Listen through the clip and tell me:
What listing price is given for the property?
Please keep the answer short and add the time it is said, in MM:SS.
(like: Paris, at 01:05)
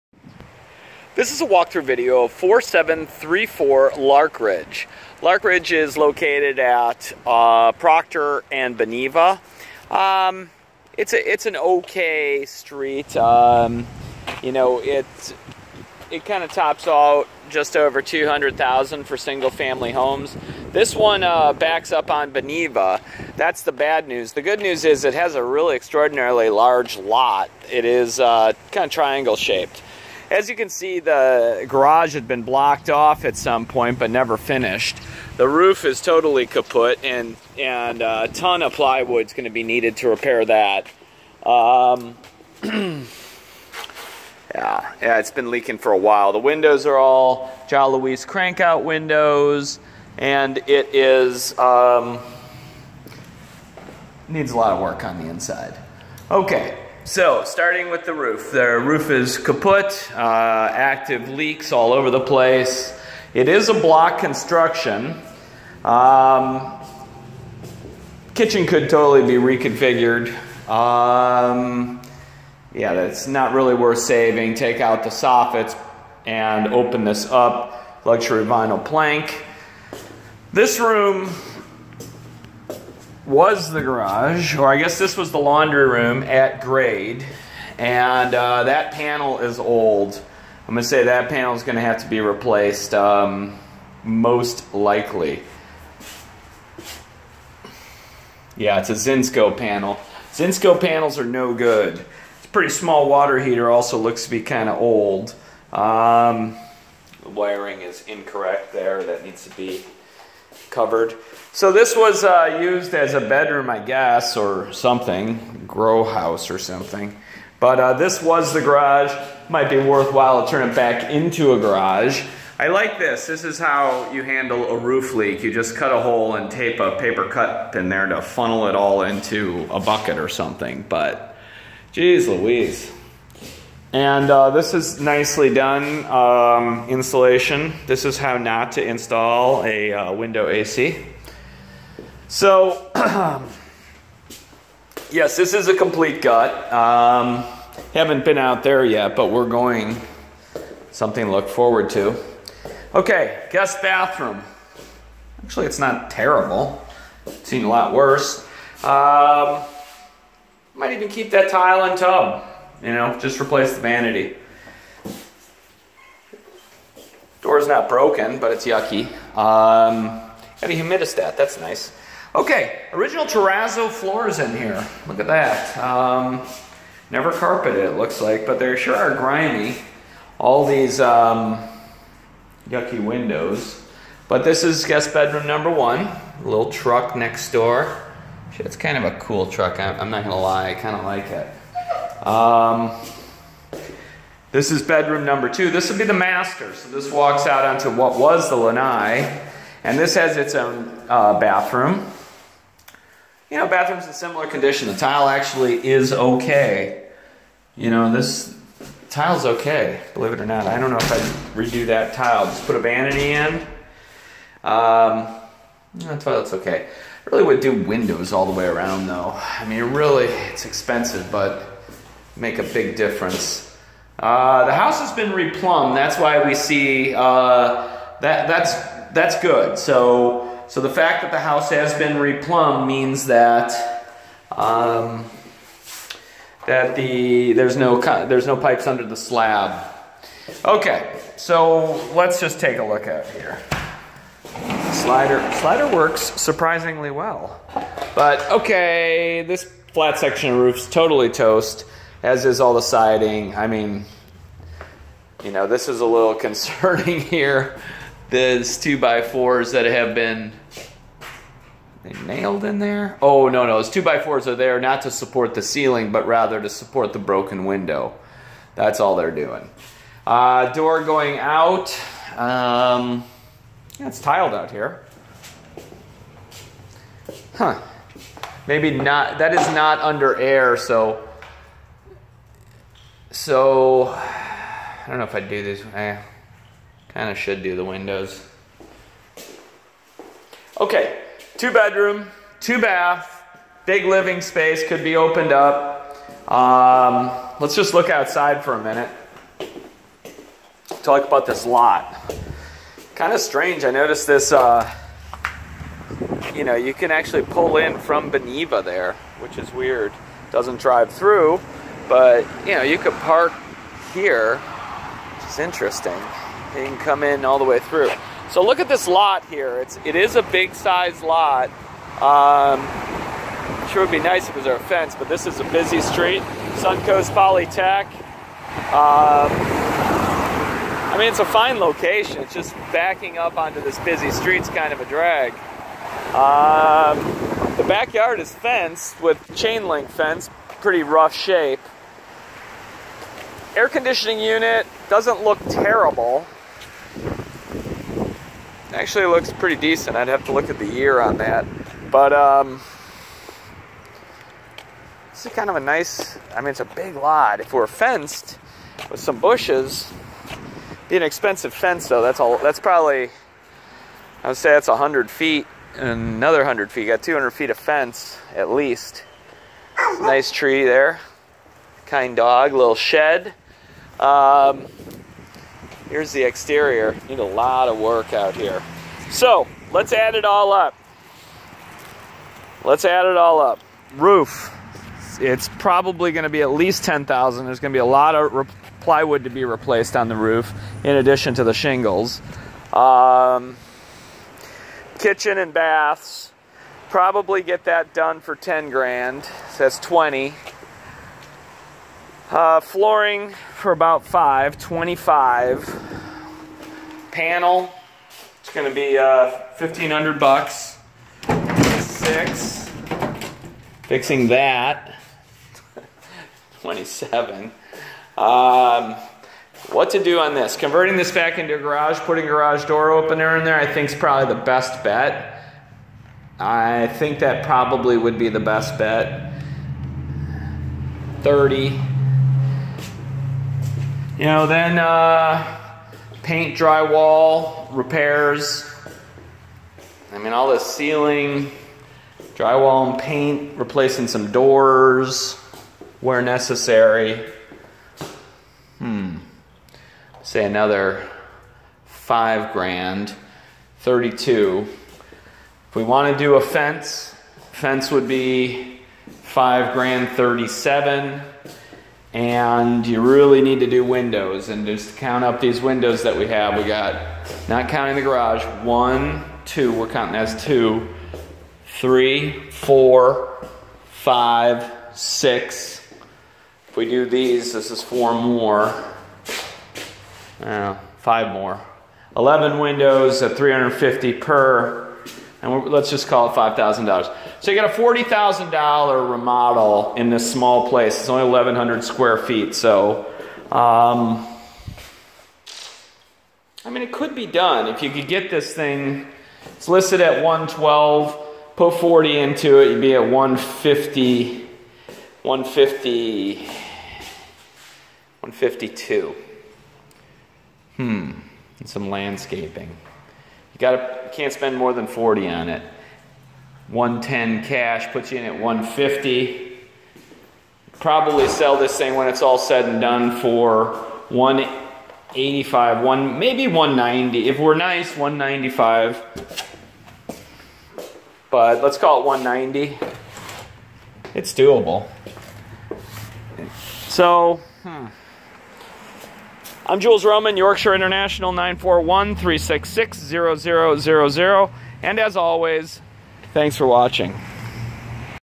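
112, at 08:20.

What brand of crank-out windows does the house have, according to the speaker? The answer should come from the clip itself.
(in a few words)
John Luis.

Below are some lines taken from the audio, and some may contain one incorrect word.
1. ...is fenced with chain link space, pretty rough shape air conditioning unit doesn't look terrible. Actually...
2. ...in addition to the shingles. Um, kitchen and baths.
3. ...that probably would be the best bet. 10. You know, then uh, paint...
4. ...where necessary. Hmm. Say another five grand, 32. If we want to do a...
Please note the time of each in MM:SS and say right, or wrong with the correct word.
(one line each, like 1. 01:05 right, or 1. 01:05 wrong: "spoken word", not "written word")
1. 05:38 wrong: "fence", not "space"
2. 06:31 right
3. 07:07 wrong: "30", not "10"
4. 07:26 right.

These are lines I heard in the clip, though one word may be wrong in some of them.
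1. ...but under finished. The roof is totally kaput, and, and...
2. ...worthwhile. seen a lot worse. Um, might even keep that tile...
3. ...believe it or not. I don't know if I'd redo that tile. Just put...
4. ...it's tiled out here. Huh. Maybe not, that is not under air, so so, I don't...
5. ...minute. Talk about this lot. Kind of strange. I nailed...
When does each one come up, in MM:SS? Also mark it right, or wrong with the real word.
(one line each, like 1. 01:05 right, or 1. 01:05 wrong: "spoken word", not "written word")
1. 00:33 wrong: "never", not "under"
2. 02:36 wrong: "terrible", not "worthwhile"
3. 03:30 right
4. 04:34 right
5. 04:58 wrong: "noticed", not "nailed".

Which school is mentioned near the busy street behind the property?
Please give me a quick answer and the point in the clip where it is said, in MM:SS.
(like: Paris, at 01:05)
Suncoast Polytech, at 05:26.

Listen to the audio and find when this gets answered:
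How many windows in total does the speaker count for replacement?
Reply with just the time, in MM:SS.
08:02.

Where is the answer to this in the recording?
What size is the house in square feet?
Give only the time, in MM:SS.
08:11.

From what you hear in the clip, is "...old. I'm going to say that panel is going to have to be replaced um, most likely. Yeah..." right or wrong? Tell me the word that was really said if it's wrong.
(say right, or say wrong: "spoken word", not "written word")
right.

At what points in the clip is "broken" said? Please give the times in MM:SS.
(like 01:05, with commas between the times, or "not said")
02:47, 04:27.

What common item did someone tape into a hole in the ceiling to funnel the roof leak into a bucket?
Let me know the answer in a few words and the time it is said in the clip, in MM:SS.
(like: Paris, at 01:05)
paper cup, at 02:06.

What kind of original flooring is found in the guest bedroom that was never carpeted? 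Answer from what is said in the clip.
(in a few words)
terrazzo.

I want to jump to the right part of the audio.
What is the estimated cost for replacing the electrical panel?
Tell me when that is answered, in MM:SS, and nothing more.
06:49.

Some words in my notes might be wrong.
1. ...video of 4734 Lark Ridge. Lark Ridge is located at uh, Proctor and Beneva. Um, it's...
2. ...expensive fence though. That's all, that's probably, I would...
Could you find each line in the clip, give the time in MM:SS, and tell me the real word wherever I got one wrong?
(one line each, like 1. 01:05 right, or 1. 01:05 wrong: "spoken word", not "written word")
1. 00:01 right
2. 06:01 right.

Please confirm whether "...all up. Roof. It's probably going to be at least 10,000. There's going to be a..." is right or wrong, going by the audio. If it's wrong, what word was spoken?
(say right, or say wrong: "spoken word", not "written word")
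right.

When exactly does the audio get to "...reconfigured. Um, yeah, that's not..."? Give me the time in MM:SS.
01:09.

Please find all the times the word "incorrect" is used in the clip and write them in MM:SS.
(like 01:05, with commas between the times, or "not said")
01:48.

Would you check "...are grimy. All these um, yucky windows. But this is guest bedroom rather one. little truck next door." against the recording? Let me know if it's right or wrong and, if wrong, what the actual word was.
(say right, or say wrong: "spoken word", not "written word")
wrong: "number", not "rather".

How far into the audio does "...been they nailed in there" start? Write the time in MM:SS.
04:20.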